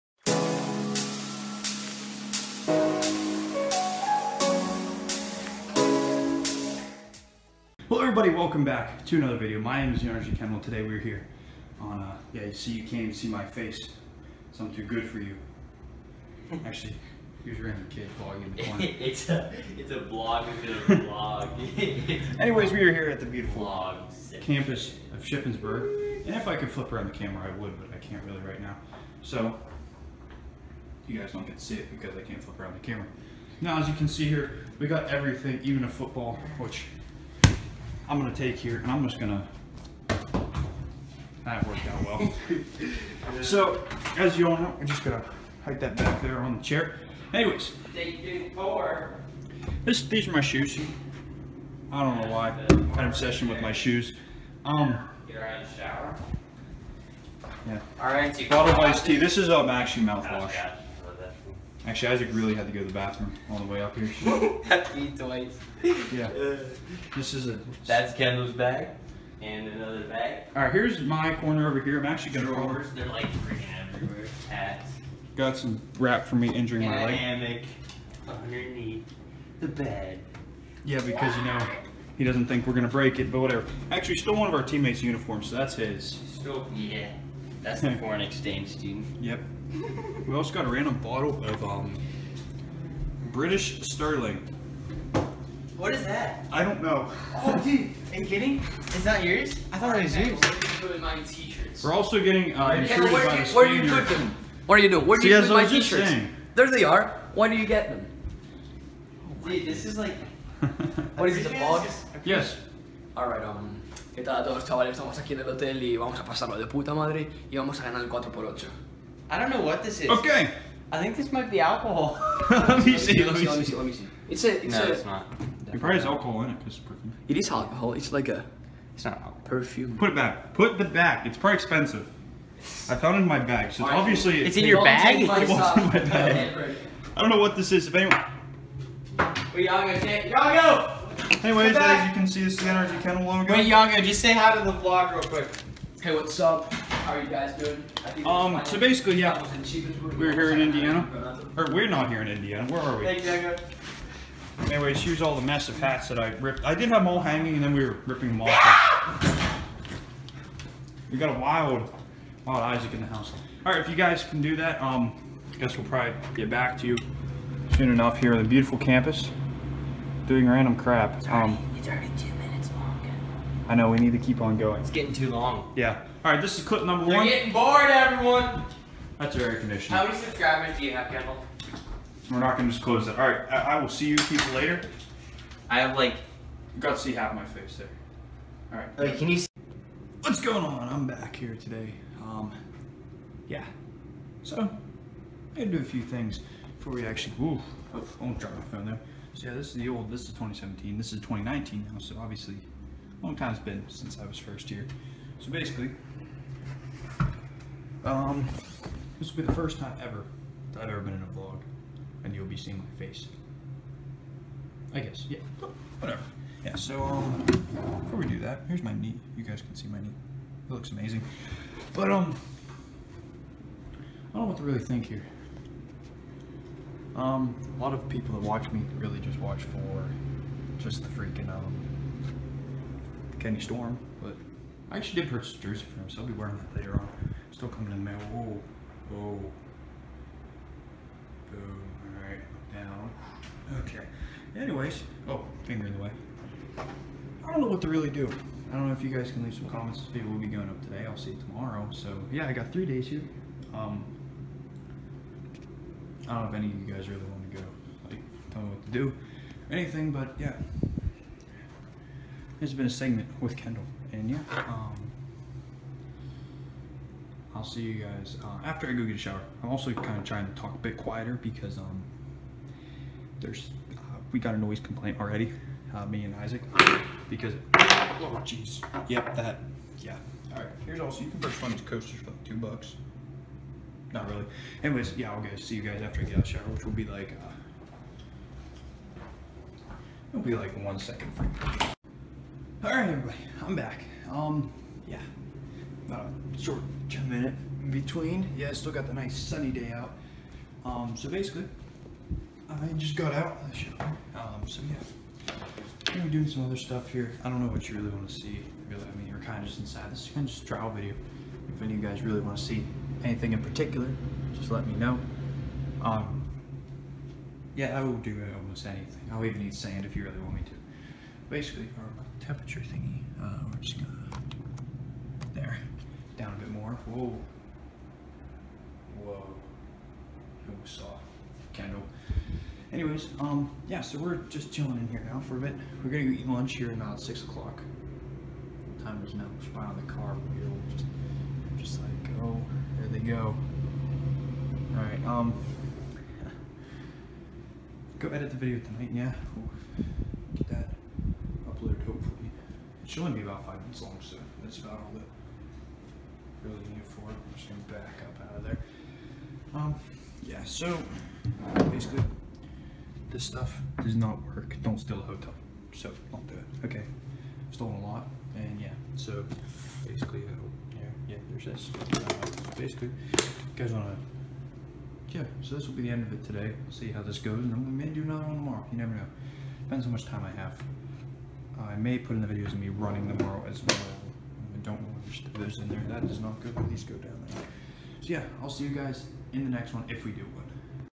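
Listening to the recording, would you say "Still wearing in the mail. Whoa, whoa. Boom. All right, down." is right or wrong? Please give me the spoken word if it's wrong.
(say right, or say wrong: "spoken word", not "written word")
wrong: "coming", not "wearing".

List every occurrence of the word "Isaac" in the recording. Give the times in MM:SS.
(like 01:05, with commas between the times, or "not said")
01:02, 02:42, 04:36.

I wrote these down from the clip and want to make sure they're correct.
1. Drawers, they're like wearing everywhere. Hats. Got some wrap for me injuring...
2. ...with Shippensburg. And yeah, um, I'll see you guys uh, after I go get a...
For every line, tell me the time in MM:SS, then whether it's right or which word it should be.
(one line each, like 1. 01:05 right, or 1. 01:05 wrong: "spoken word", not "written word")
1. 01:12 wrong: "freaking", not "wearing"
2. 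04:23 wrong: "Kendall", not "Shippensburg".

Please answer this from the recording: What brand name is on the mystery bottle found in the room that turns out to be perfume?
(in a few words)
British Sterling.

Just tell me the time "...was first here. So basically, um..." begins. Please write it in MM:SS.
03:24.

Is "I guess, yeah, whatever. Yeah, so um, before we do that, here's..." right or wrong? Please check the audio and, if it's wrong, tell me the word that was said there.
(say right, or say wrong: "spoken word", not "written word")
right.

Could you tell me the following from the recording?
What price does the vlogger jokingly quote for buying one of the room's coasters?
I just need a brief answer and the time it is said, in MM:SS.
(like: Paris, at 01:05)
$2, at 04:42.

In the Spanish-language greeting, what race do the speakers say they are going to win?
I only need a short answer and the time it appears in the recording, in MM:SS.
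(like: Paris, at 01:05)
the 4x8, at 01:58.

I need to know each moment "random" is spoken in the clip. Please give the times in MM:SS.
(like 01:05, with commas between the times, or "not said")
00:17, 01:30, 02:50.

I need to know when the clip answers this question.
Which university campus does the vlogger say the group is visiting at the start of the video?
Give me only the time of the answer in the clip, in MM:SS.
00:25.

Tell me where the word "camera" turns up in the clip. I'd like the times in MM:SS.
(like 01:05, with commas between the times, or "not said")
00:27, 00:32.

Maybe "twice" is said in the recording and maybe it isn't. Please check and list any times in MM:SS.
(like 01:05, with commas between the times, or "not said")
01:05.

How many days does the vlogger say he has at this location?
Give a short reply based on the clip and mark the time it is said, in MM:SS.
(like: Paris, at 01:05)
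3, at 04:12.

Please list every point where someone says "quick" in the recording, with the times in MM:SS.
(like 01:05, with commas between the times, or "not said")
02:25.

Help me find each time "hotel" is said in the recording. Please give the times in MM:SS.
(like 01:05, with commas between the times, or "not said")
01:55, 06:05.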